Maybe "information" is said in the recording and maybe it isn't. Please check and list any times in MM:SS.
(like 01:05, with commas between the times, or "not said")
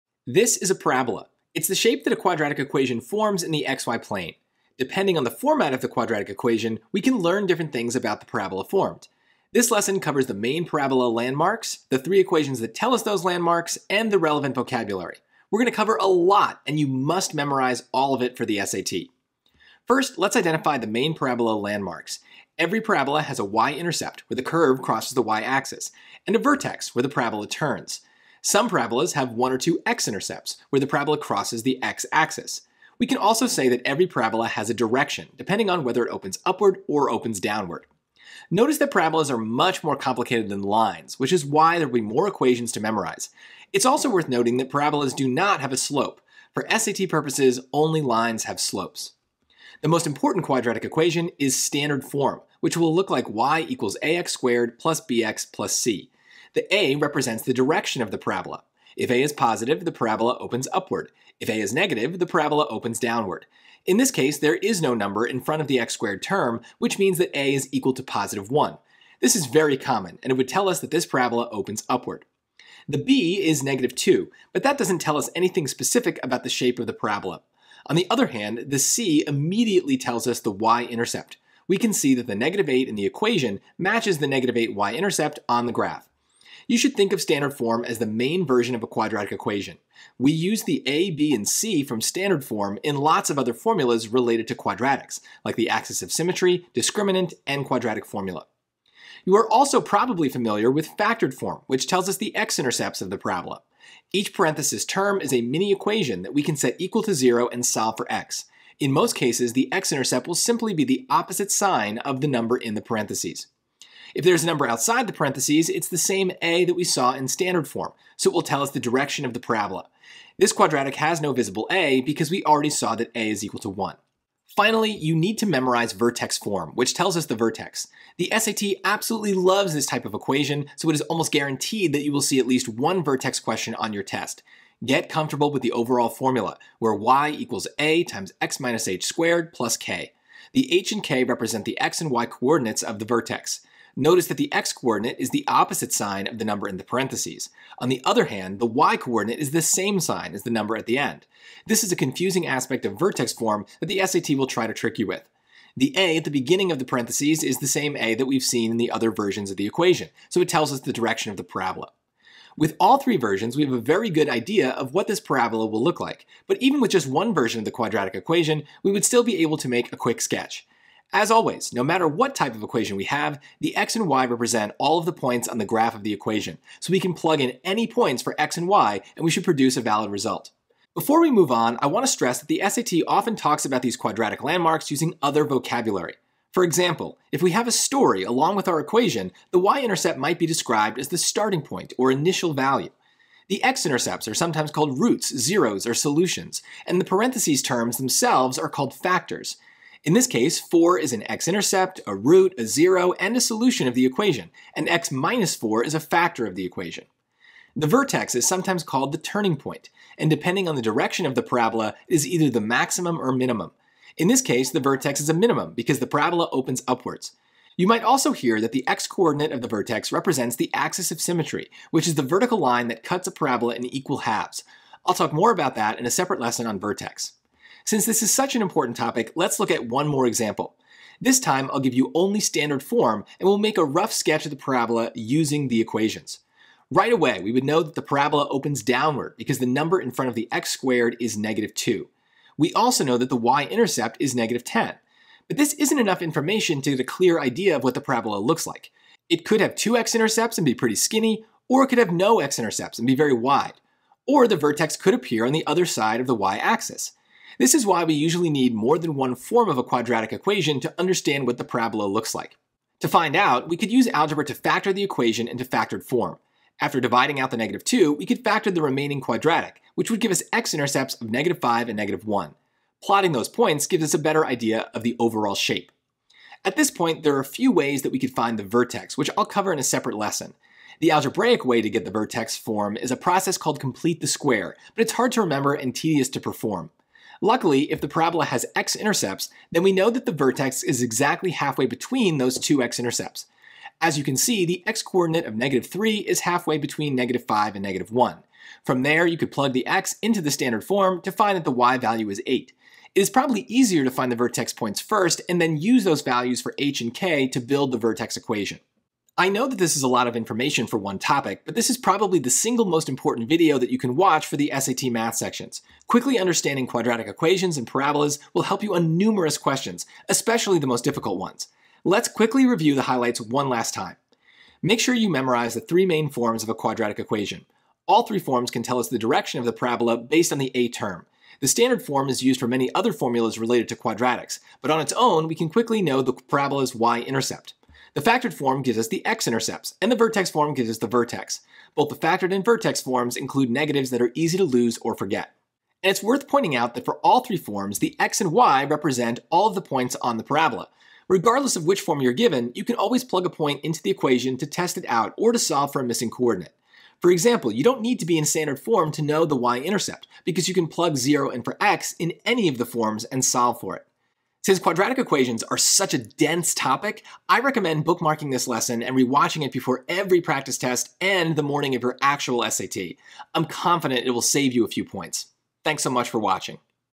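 04:06, 05:10.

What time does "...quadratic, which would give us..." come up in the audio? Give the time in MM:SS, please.
04:29.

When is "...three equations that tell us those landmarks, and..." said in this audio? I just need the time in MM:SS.
00:11.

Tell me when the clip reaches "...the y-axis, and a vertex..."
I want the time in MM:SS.
00:25.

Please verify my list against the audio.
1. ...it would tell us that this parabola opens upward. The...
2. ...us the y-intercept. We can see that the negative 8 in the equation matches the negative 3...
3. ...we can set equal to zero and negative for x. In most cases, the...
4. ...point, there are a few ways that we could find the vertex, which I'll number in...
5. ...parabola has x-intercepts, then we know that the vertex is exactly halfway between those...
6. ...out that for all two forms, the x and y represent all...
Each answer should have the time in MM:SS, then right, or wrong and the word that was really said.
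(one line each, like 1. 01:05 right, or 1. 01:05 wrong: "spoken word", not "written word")
1. 01:10 right
2. 01:20 wrong: "8", not "3"
3. 01:46 wrong: "solve", not "negative"
4. 04:36 wrong: "cover", not "number"
5. 04:48 right
6. 05:46 wrong: "three", not "two".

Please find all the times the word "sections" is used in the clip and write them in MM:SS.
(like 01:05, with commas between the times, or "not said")
05:15.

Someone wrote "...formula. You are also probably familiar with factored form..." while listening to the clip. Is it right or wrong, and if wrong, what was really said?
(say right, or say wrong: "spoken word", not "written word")
right.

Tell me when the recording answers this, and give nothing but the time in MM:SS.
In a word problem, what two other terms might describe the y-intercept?
03:11.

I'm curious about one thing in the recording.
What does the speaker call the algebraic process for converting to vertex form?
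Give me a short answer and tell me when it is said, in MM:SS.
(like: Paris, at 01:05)
Complete the square, at 04:43.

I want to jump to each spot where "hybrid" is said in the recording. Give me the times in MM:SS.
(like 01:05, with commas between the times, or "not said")
not said.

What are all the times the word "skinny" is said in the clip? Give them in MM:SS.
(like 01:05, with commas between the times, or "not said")
04:10.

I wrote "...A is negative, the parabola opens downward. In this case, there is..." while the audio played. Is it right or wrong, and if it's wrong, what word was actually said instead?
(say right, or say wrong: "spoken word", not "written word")
right.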